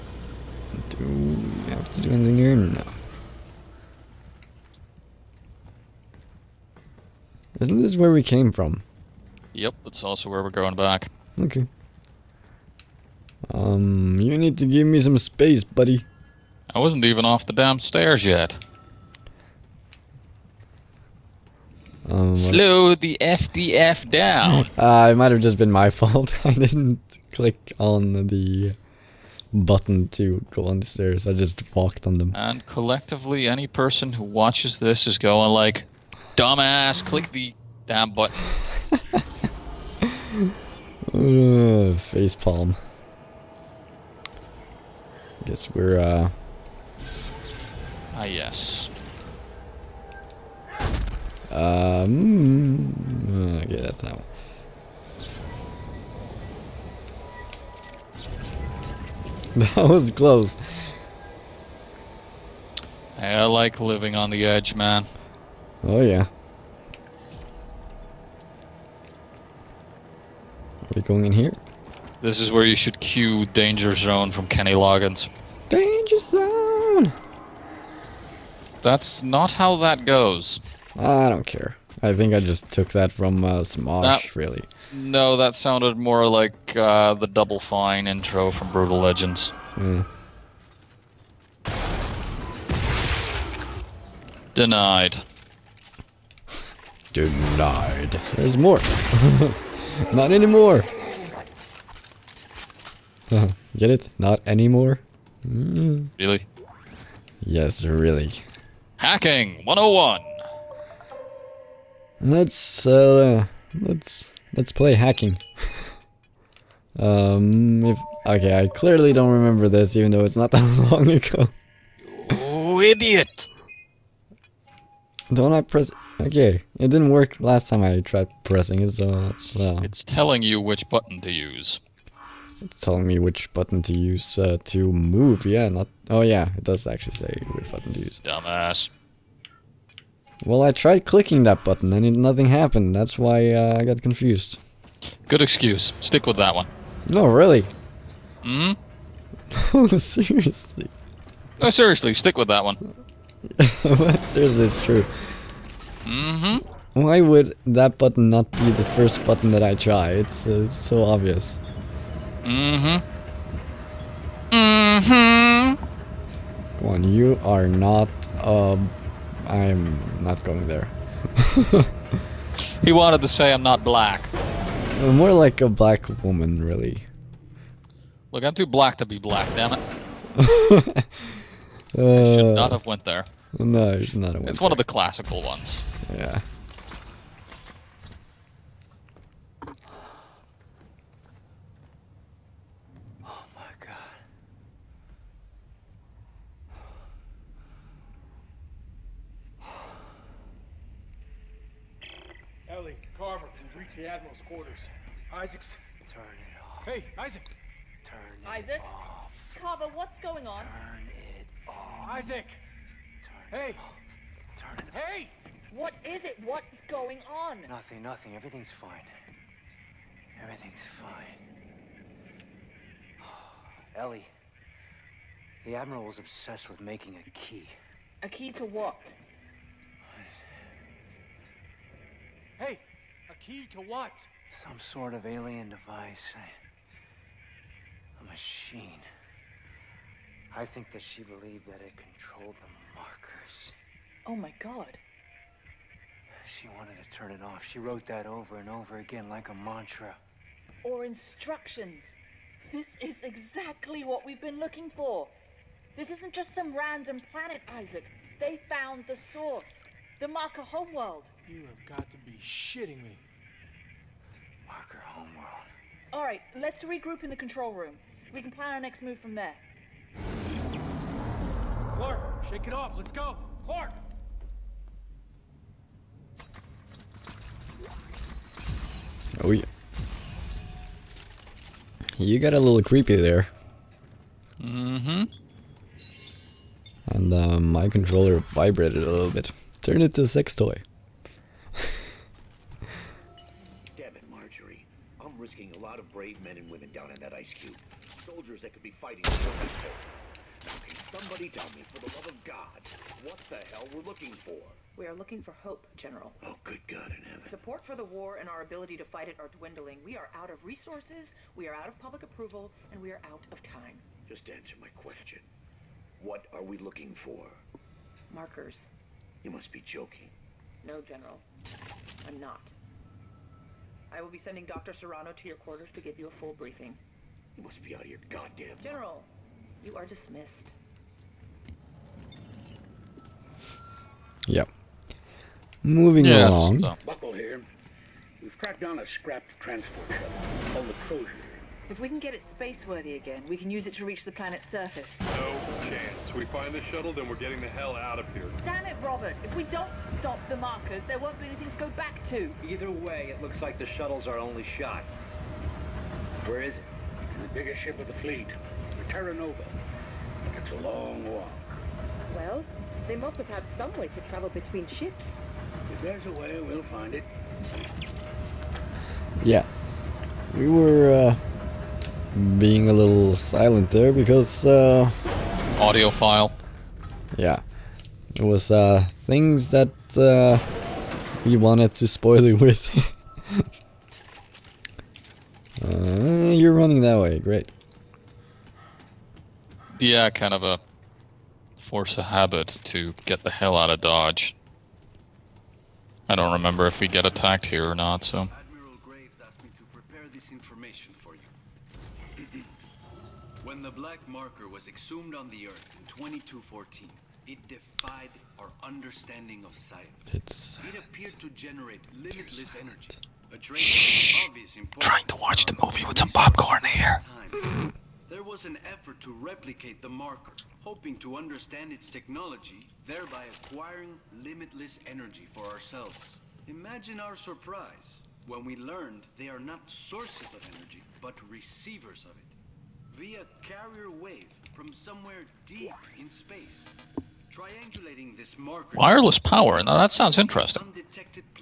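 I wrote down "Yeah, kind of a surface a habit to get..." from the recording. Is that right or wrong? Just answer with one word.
wrong.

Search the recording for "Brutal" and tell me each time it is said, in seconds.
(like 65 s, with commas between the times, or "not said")
88 s.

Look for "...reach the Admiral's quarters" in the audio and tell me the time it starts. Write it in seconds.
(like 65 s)
203 s.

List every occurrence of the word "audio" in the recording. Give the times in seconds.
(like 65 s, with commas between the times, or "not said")
375 s.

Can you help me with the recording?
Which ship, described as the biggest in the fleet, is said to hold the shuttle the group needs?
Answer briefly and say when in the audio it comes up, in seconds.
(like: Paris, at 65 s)
Terra Nova, at 359 s.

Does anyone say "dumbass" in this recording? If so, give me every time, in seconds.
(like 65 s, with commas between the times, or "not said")
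36 s, 138 s.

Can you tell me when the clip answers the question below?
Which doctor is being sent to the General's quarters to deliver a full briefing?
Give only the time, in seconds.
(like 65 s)
324 s.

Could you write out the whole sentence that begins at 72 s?
This is where you should cue Danger Zone from Kenny Loggins.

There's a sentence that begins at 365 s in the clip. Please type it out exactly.
If there's a way, we'll find it.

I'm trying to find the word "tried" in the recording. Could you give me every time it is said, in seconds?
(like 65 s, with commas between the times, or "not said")
128 s, 140 s.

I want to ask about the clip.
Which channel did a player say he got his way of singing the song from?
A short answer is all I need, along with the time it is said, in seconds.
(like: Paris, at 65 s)
Smosh, at 83 s.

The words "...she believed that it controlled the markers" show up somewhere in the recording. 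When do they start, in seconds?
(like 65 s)
241 s.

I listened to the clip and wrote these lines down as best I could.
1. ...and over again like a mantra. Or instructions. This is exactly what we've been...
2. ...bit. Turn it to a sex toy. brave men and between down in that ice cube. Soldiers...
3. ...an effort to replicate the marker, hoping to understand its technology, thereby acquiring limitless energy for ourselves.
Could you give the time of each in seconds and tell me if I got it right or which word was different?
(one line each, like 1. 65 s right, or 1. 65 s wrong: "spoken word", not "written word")
1. 248 s right
2. 289 s wrong: "women", not "between"
3. 418 s right.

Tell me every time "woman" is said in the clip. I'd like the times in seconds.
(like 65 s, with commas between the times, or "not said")
176 s.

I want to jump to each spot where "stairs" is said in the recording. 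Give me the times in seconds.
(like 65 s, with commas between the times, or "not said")
17 s, 30 s.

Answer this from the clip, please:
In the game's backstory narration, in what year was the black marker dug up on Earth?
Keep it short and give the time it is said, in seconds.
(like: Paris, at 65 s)
2214, at 406 s.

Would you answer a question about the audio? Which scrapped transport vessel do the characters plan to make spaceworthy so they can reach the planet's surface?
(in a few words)
Crozier.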